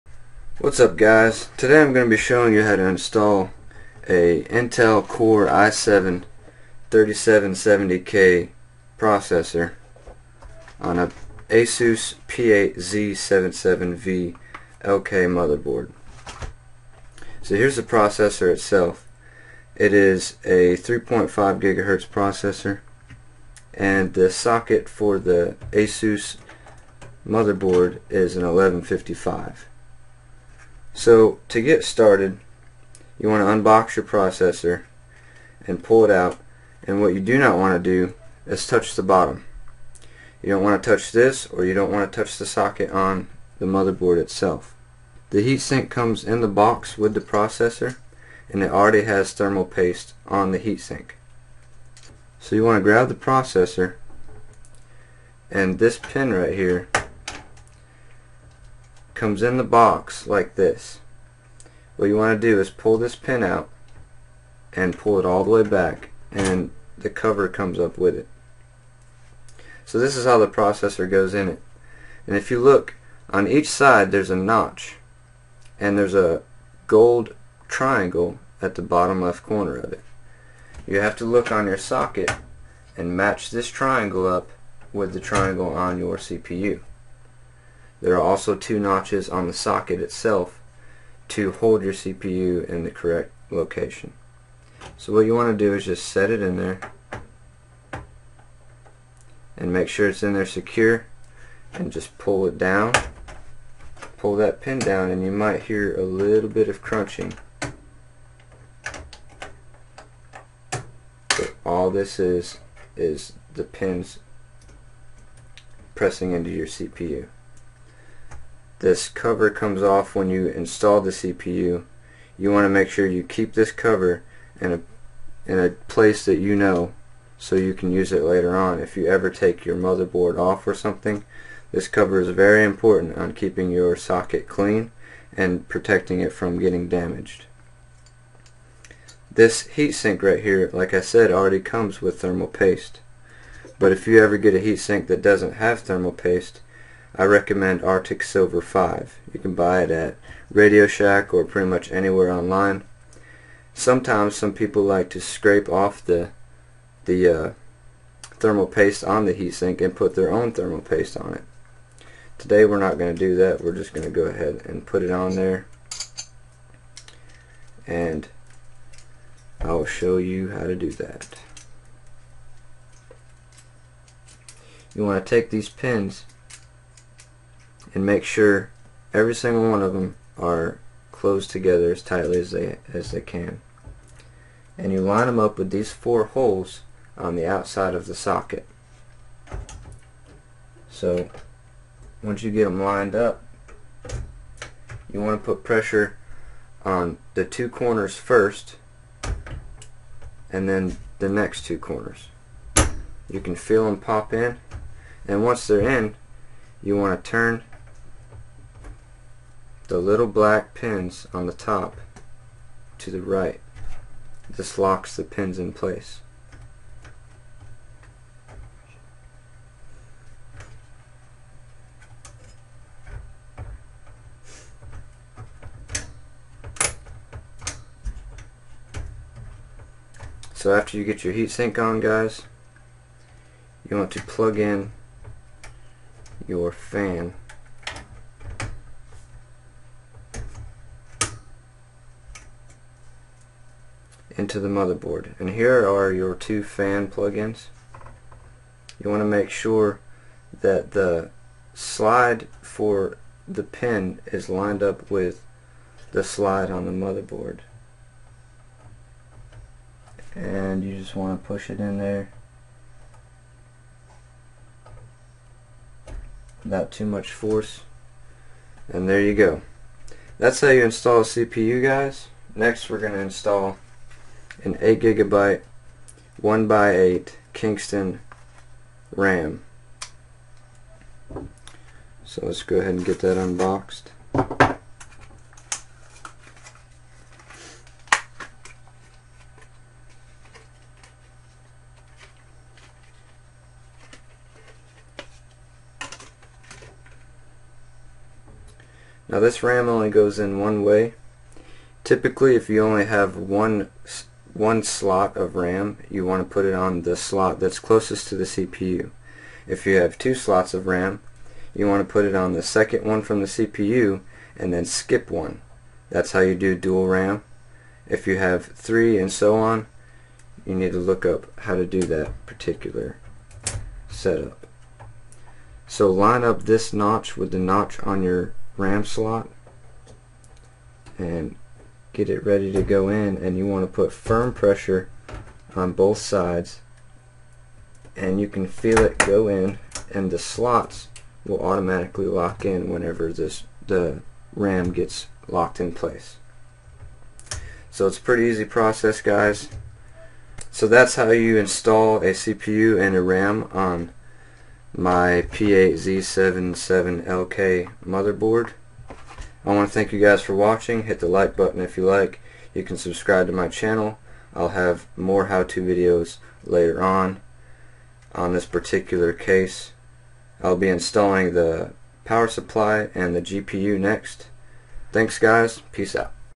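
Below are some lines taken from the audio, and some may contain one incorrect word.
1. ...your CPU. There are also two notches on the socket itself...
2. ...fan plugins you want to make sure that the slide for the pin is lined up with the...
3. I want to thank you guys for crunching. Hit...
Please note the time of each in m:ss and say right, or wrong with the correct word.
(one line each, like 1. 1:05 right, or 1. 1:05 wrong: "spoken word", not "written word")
1. 1:25 right
2. 4:06 right
3. 5:59 wrong: "watching", not "crunching".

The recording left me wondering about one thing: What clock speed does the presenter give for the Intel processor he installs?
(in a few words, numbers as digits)
3.5 GHz.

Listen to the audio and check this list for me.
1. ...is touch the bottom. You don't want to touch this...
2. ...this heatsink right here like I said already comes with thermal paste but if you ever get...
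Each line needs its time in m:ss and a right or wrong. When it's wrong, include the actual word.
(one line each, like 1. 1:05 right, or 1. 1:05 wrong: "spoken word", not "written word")
1. 0:38 right
2. 2:19 right.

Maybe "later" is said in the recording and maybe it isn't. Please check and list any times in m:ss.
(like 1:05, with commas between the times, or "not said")
2:08, 6:06.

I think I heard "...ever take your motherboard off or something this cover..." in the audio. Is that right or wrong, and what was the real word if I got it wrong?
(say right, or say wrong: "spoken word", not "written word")
right.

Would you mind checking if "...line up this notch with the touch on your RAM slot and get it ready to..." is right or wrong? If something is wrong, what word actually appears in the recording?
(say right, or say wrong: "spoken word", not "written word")
wrong: "notch", not "touch".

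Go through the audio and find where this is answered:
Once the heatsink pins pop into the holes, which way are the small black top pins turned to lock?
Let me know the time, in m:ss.
3:32.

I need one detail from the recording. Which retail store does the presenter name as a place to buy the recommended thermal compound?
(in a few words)
Radio Shack.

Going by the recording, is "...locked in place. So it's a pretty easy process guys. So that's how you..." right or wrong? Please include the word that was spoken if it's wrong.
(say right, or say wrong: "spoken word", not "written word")
right.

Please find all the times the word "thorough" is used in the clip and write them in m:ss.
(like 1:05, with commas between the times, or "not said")
not said.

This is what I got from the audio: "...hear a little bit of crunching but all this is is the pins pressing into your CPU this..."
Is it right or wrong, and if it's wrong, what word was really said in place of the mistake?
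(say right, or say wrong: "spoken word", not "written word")
right.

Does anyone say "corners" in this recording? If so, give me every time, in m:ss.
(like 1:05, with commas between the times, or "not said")
1:19, 3:17, 3:21.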